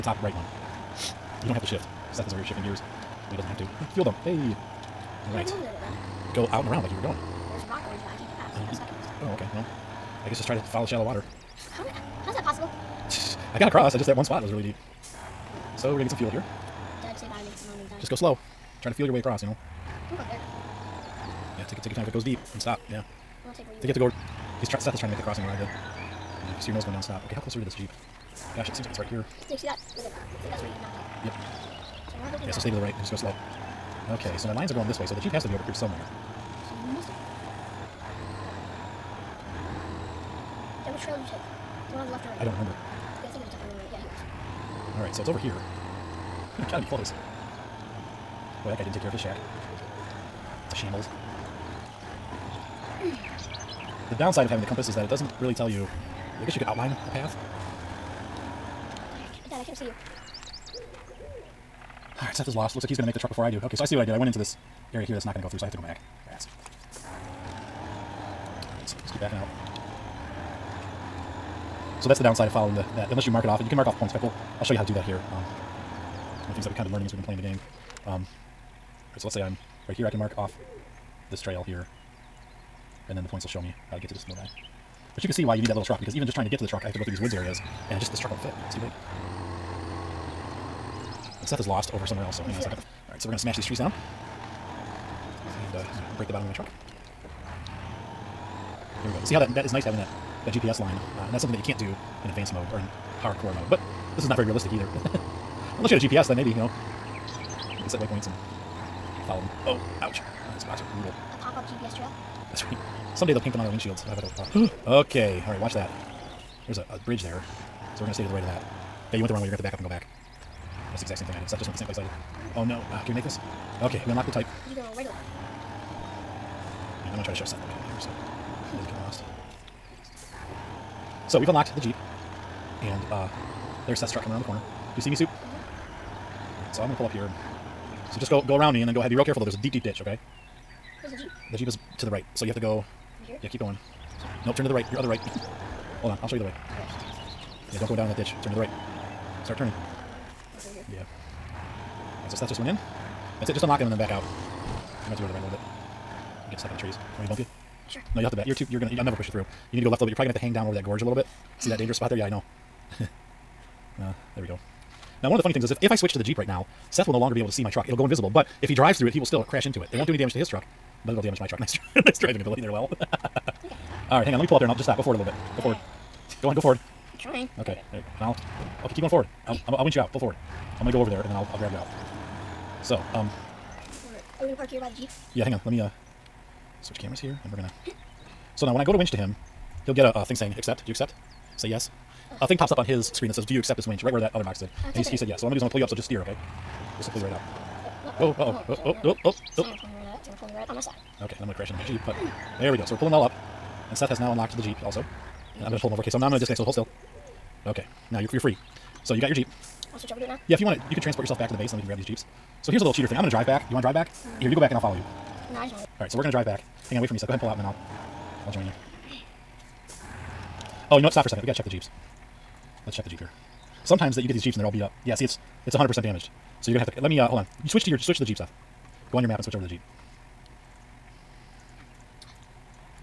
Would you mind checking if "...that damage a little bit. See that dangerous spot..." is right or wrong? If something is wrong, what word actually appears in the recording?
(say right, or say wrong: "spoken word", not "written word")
wrong: "gorge", not "damage".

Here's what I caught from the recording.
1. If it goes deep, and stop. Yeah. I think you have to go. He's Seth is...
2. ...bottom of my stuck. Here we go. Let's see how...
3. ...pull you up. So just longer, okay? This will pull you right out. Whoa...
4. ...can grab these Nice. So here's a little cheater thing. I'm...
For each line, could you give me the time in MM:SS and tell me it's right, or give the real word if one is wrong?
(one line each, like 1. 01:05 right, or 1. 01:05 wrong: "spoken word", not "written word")
1. 00:22 right
2. 01:36 wrong: "truck", not "stuck"
3. 03:15 wrong: "steer", not "longer"
4. 03:31 wrong: "Jeeps", not "Nice".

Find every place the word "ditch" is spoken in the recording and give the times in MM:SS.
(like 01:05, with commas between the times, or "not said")
02:19, 02:28.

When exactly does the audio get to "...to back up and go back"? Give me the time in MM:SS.
01:59.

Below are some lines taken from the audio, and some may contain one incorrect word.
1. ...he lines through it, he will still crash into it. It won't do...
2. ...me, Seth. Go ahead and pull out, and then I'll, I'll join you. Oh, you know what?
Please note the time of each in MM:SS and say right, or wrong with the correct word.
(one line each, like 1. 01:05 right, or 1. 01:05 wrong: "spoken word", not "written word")
1. 02:48 wrong: "drives", not "lines"
2. 03:37 right.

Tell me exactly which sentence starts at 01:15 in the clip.
Um, one of the things that we've kind of been learning as we've been playing the game.